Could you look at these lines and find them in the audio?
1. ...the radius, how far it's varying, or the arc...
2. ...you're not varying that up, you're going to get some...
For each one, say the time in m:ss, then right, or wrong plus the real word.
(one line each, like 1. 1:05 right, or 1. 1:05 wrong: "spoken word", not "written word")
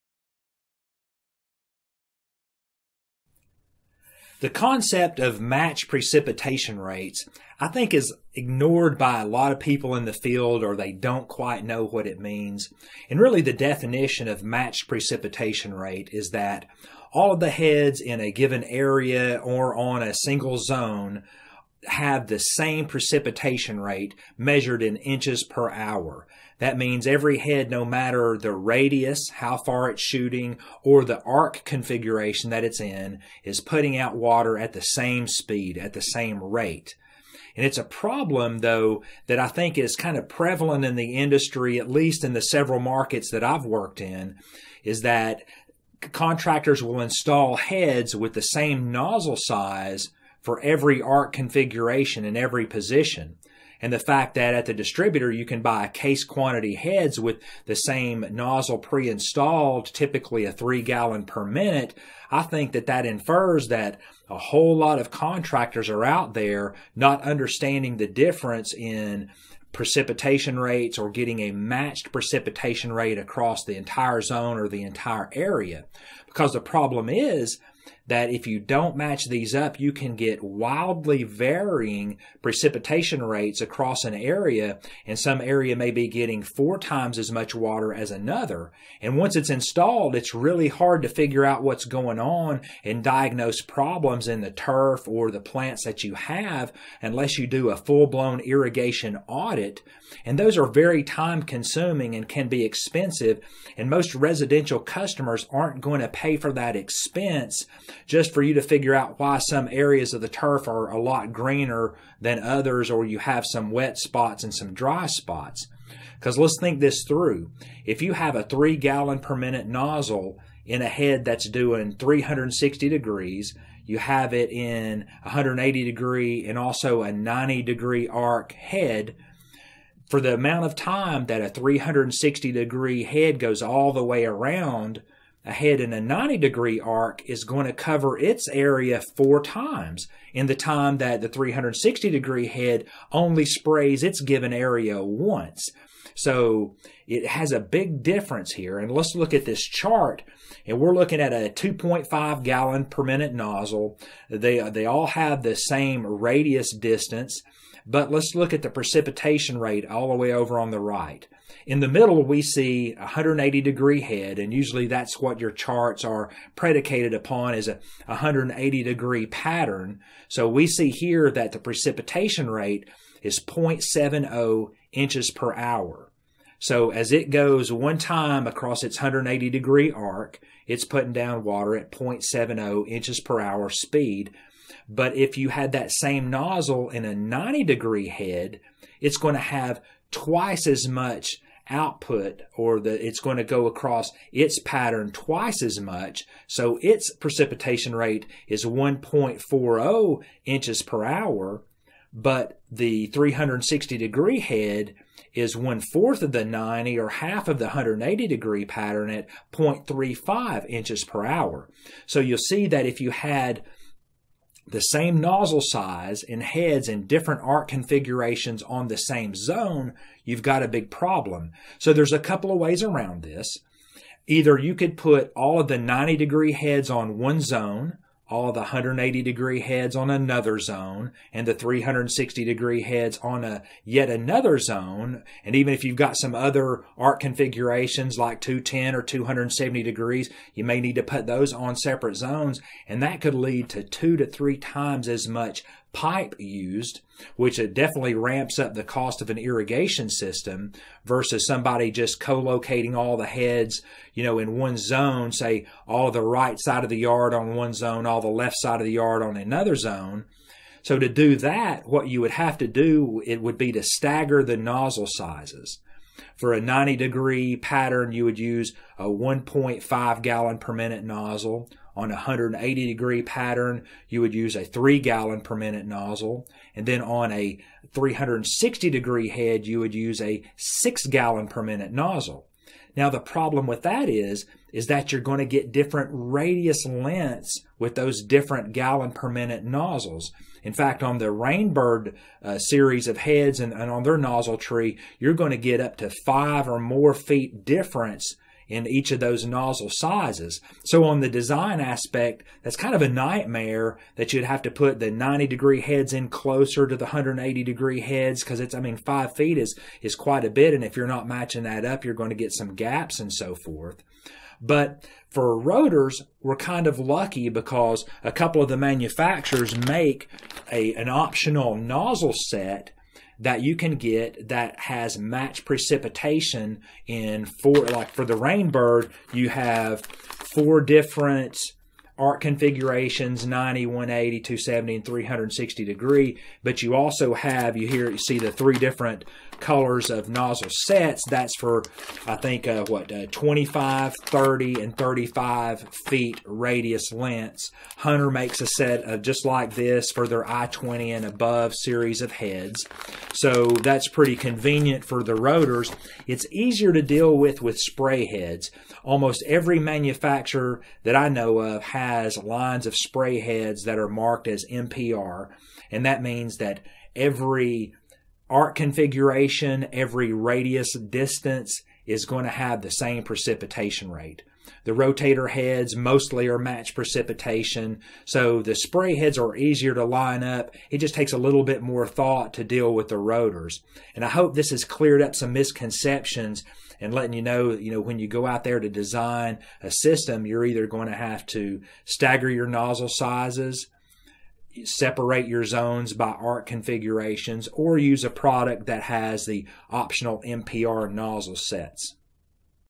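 1. 0:28 wrong: "shooting", not "varying"
2. 5:10 wrong: "matching", not "varying".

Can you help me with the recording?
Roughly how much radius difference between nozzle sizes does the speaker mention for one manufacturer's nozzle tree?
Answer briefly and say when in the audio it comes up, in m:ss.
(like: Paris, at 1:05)
5 or more feet, at 4:56.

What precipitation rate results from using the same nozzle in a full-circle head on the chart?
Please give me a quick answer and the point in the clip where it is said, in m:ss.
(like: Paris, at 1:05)
0.35 inches per hour, at 3:29.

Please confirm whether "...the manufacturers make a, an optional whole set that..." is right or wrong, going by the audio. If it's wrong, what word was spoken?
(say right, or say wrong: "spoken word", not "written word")
wrong: "nozzle", not "whole".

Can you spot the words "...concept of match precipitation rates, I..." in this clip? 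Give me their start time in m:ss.
0:04.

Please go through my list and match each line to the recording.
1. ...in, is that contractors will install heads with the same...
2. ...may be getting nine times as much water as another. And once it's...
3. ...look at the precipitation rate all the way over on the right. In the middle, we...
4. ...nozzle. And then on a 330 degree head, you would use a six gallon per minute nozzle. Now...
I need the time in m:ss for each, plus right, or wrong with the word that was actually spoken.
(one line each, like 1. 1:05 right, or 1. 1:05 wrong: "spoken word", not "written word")
1. 0:43 right
2. 1:25 wrong: "four", not "nine"
3. 2:38 right
4. 4:35 wrong: "360", not "330".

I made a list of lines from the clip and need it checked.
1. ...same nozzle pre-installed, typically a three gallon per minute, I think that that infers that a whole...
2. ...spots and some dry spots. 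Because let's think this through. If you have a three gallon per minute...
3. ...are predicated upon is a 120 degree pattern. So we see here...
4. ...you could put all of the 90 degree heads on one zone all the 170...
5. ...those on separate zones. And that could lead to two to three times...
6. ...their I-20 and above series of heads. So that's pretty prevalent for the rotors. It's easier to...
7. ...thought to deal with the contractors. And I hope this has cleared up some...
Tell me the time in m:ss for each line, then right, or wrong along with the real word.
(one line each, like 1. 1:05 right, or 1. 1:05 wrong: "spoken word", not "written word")
1. 0:57 right
2. 1:53 right
3. 2:46 wrong: "180", not "120"
4. 3:44 wrong: "180", not "170"
5. 4:01 right
6. 5:50 wrong: "convenient", not "prevalent"
7. 6:22 wrong: "rotors", not "contractors".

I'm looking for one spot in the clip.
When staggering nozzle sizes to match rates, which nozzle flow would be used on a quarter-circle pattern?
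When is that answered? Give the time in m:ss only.
4:29.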